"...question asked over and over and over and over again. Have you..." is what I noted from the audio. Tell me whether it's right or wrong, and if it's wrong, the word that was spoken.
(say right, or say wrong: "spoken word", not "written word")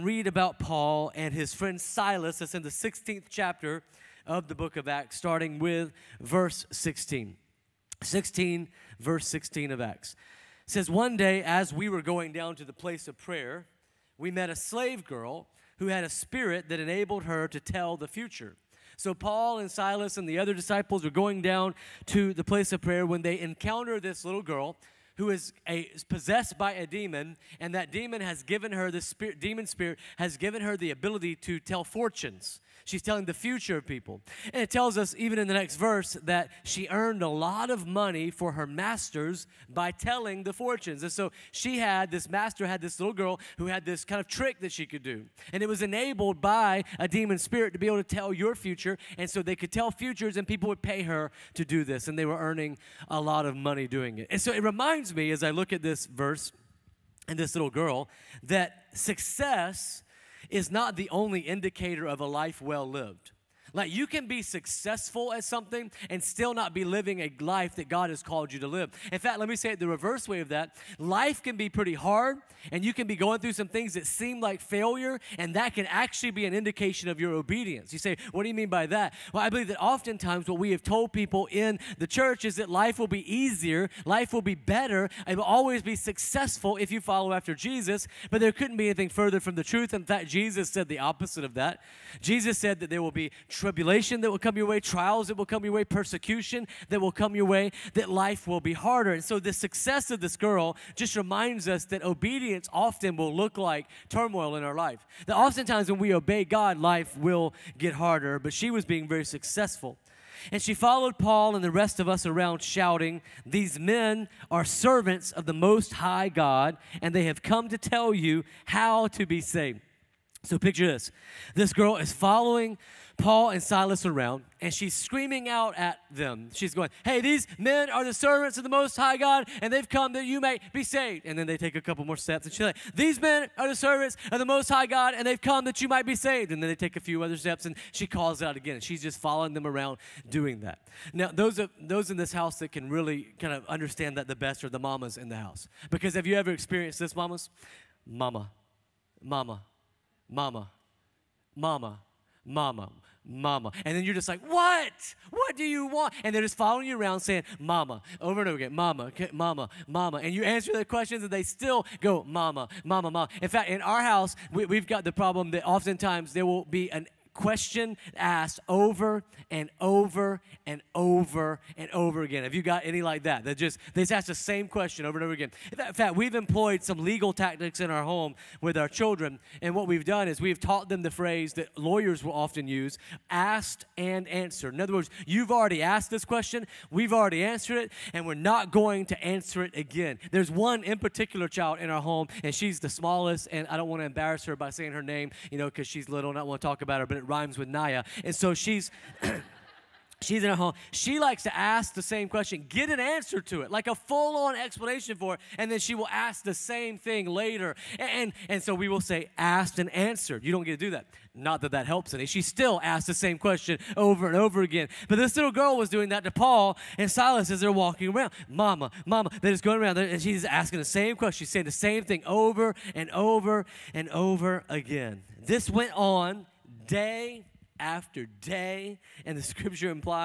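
right.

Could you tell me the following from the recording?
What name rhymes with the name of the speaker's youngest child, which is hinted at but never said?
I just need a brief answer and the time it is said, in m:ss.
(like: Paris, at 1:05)
Naya, at 3:17.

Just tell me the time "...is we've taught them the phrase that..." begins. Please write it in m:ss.
3:00.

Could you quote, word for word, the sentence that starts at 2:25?
Because have you ever experienced this, mamas?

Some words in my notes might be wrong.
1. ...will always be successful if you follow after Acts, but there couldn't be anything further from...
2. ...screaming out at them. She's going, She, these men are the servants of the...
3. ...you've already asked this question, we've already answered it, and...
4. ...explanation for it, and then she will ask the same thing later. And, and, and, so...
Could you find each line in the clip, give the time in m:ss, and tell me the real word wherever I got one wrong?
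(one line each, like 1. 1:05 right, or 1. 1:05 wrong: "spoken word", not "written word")
1. 1:25 wrong: "Jesus", not "Acts"
2. 2:04 wrong: "Hey", not "She"
3. 3:05 right
4. 3:24 right.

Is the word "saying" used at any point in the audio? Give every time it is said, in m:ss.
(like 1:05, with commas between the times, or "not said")
2:37, 3:14, 3:41.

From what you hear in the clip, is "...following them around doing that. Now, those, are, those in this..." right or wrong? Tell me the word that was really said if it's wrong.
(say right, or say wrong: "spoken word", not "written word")
right.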